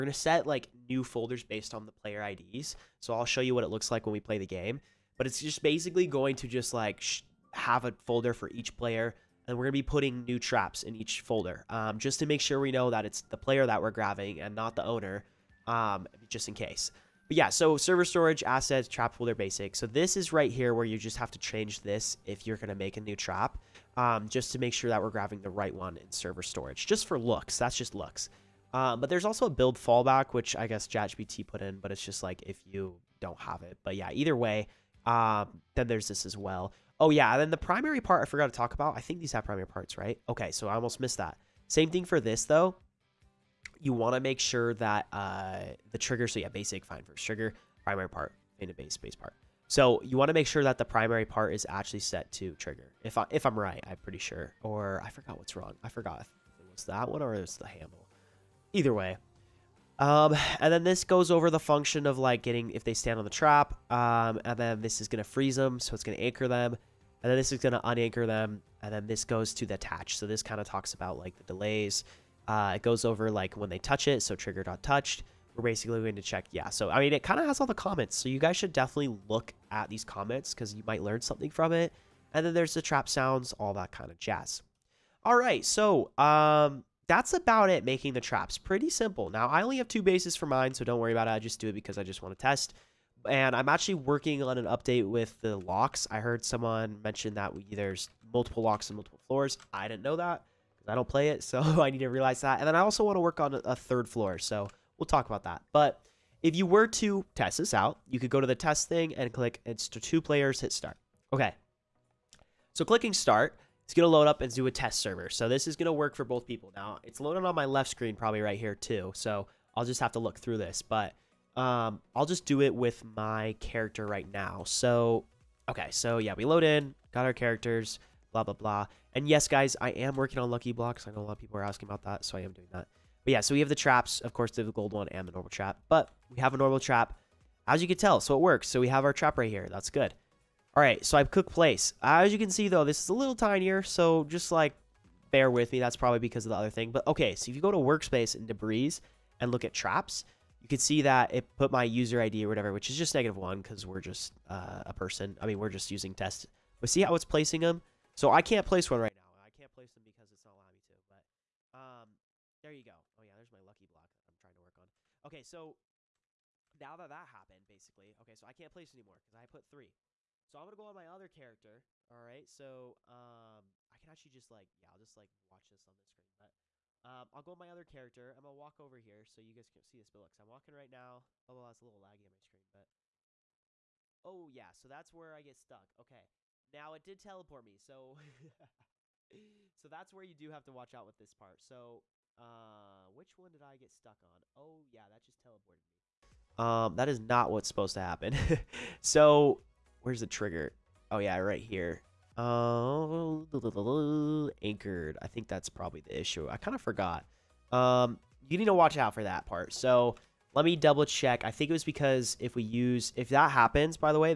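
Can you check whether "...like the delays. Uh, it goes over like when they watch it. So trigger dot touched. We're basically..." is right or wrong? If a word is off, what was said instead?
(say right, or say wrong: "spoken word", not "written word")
wrong: "touch", not "watch".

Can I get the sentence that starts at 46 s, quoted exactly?
So yeah, basic fine first trigger, primary part, in a base base part.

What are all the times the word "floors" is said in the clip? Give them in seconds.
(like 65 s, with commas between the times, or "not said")
99 s, 104 s.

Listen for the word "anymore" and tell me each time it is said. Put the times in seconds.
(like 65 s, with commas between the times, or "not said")
168 s.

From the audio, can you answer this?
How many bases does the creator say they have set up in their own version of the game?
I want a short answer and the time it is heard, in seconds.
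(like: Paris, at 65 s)
2, at 89 s.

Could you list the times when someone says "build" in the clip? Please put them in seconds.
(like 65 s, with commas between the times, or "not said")
29 s, 180 s.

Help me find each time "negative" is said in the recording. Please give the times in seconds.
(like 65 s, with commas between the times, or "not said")
153 s.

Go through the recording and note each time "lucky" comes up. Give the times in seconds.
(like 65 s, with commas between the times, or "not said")
130 s, 163 s.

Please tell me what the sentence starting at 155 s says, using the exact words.
I mean, we're just using test.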